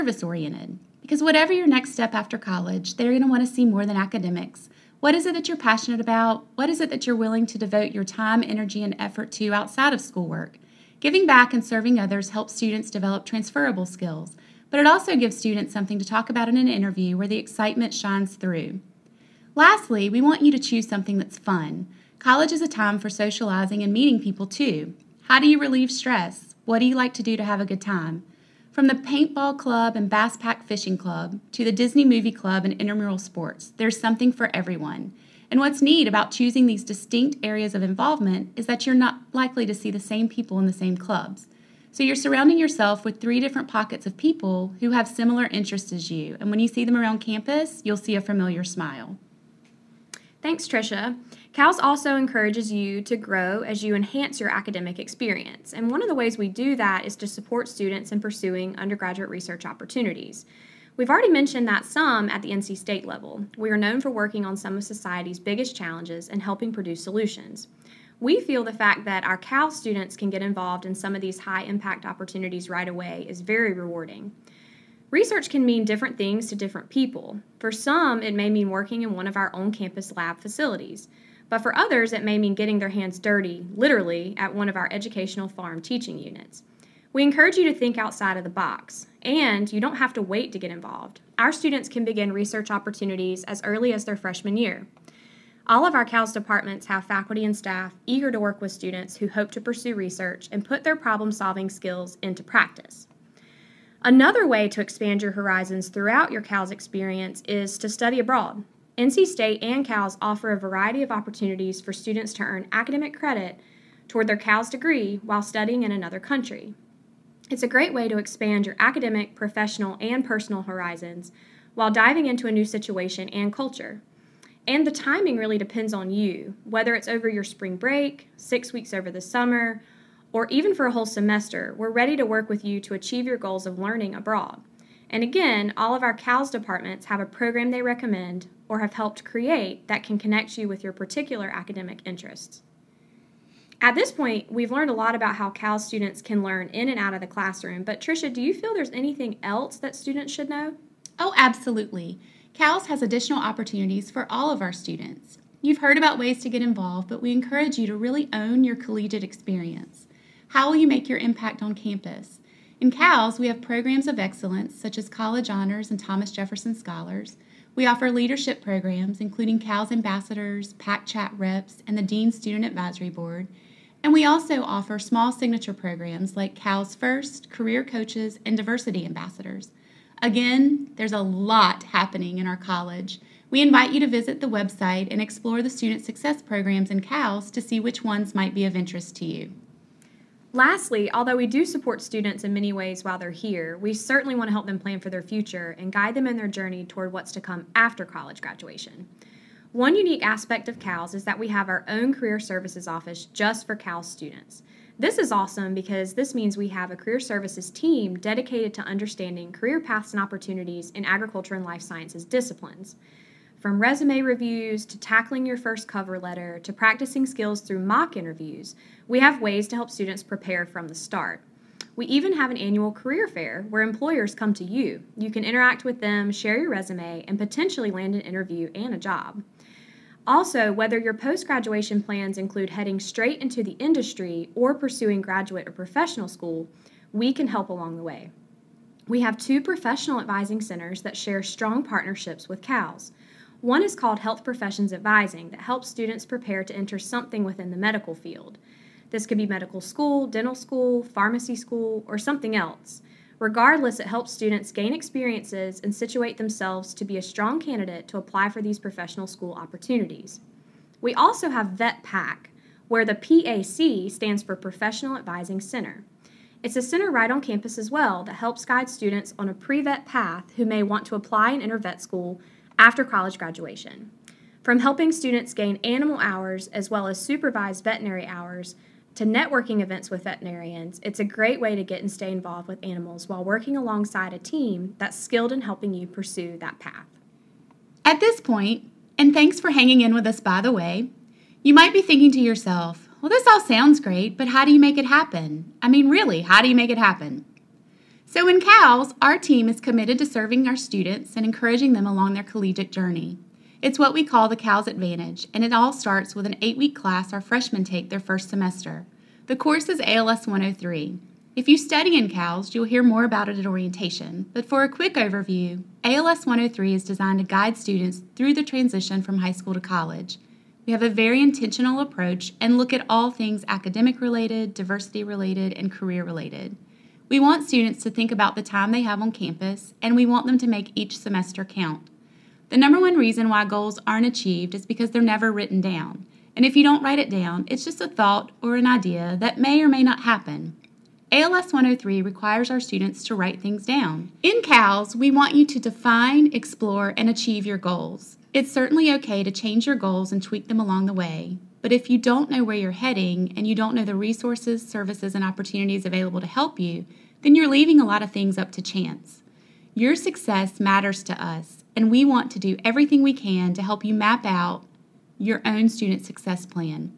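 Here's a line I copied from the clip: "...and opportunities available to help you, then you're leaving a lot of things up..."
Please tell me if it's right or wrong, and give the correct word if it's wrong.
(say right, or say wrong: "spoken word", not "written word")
right.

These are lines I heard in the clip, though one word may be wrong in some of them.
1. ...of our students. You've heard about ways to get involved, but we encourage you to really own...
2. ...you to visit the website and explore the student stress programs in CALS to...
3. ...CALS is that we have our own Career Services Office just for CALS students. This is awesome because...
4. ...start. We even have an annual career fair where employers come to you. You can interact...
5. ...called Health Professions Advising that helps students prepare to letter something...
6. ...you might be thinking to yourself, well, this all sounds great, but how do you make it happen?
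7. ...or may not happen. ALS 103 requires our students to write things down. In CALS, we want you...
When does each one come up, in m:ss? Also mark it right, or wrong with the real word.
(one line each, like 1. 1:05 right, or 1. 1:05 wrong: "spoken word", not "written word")
1. 2:34 right
2. 3:03 wrong: "success", not "stress"
3. 3:20 right
4. 3:40 right
5. 4:03 wrong: "enter", not "letter"
6. 4:51 right
7. 5:39 right.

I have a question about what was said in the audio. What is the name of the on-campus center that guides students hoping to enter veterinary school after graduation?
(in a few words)
VetPAC.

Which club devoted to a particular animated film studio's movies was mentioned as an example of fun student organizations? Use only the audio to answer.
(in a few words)
Disney movie club.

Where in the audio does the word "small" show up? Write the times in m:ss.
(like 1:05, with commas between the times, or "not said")
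2:54.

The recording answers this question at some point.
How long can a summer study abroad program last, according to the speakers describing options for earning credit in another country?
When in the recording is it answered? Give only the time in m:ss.
2:08.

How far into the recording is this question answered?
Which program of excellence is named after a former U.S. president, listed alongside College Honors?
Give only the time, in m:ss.
2:45.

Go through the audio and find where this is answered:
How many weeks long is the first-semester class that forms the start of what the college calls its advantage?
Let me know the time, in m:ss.
5:06.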